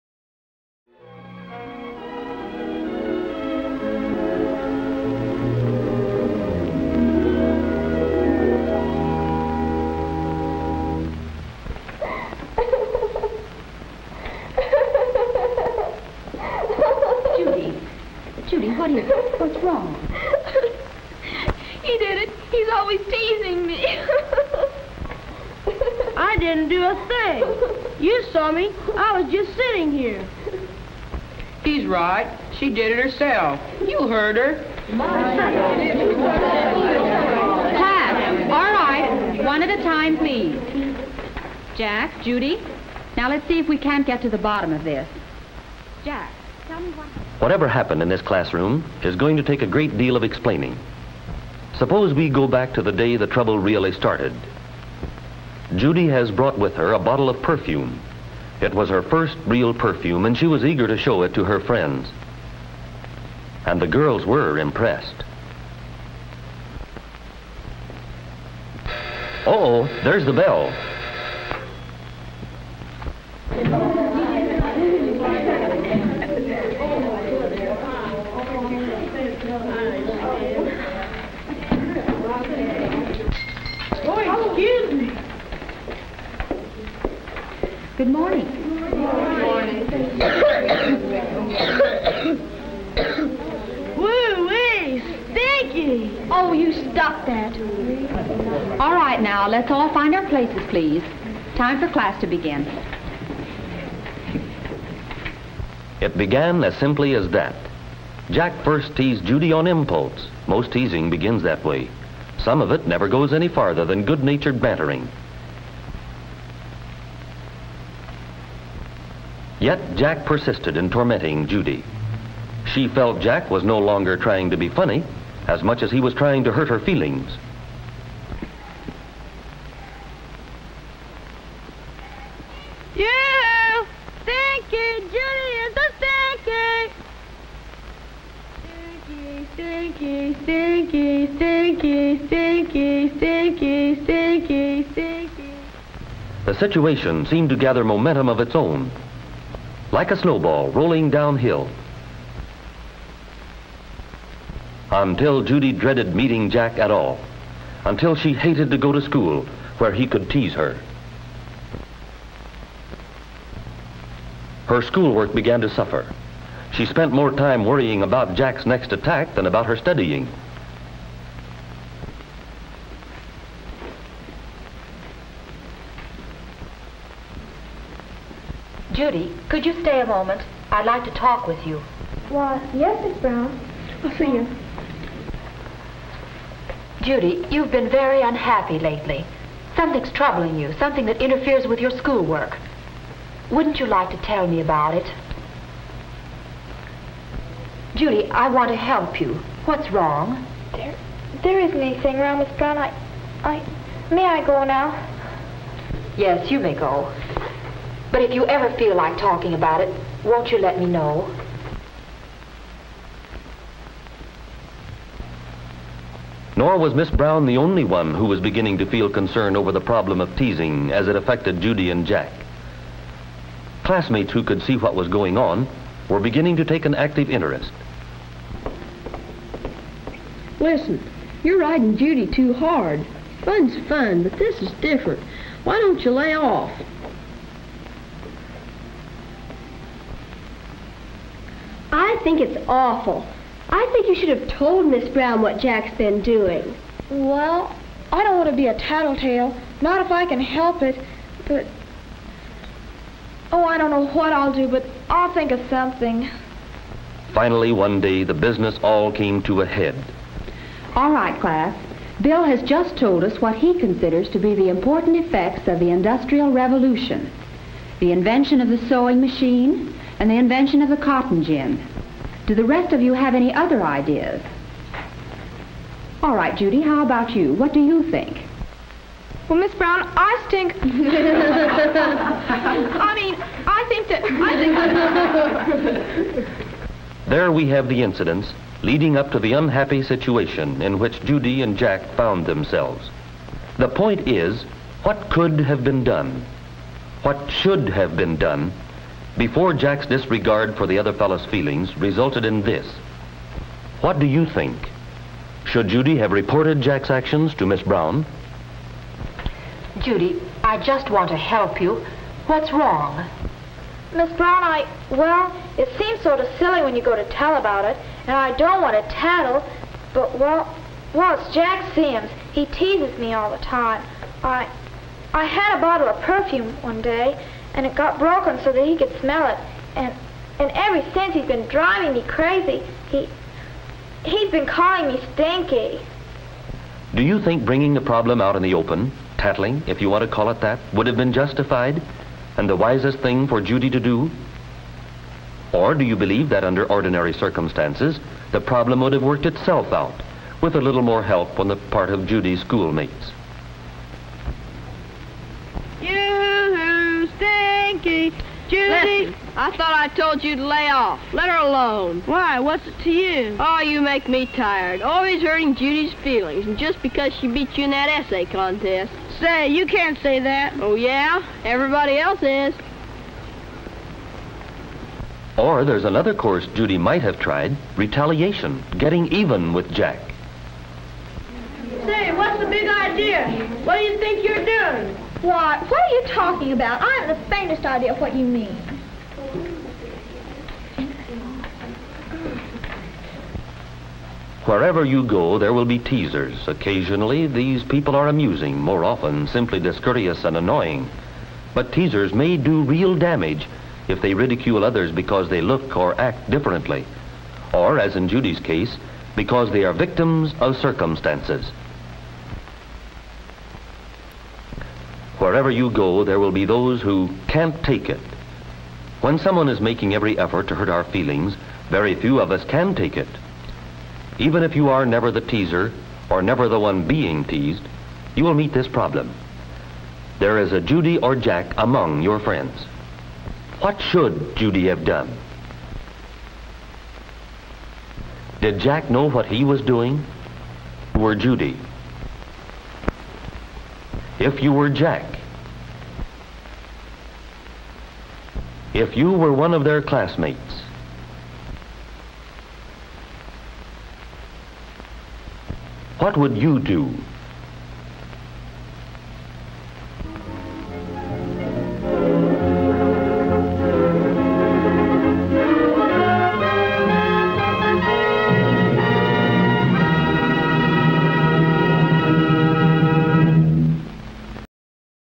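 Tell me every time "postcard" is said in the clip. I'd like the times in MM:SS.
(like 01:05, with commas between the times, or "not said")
not said.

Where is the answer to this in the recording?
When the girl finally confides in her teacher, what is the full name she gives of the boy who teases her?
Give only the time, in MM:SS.
05:21.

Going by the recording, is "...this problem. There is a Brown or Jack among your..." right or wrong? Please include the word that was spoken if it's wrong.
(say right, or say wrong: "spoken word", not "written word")
wrong: "Judy", not "Brown".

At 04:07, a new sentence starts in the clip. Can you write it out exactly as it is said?
Well, I don't want to be a tattletale, not if I can help it, but...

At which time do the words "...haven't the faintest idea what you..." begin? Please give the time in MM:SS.
06:27.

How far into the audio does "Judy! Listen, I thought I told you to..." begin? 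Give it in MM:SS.
05:58.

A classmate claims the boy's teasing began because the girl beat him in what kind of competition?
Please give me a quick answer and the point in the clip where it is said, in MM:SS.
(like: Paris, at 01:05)
Essay contest, at 06:08.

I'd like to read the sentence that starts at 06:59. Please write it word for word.
When someone is making every effort to hurt our feelings, very few of us can take it.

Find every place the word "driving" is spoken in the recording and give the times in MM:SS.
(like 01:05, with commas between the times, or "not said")
05:31.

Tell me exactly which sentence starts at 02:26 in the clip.
The situation seemed to gather momentum of its own, like a snowball rolling downhill.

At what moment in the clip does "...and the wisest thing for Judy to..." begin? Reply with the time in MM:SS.
05:42.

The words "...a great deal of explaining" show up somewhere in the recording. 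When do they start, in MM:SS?
00:49.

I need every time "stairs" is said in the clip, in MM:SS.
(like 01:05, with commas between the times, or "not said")
not said.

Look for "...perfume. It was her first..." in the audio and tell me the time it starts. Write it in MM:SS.
00:57.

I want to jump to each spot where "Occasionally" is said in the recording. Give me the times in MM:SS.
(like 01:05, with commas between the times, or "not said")
06:36.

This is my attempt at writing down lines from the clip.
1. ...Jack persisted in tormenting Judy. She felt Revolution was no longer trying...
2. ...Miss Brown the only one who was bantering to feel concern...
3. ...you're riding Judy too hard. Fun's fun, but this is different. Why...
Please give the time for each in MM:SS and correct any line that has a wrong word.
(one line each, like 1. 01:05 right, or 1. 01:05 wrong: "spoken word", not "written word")
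1. 01:59 wrong: "Jack", not "Revolution"
2. 03:36 wrong: "beginning", not "bantering"
3. 03:51 right.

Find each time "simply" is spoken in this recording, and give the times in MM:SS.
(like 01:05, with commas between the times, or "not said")
01:46, 06:39.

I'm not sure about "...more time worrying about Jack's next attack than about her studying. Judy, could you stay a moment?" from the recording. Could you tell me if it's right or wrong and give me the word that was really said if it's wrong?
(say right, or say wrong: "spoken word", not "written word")
right.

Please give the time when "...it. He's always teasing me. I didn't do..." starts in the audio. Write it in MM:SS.
00:22.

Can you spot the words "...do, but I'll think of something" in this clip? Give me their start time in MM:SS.
04:14.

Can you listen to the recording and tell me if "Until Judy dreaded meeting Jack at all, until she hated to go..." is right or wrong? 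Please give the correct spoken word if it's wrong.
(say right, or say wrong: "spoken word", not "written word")
right.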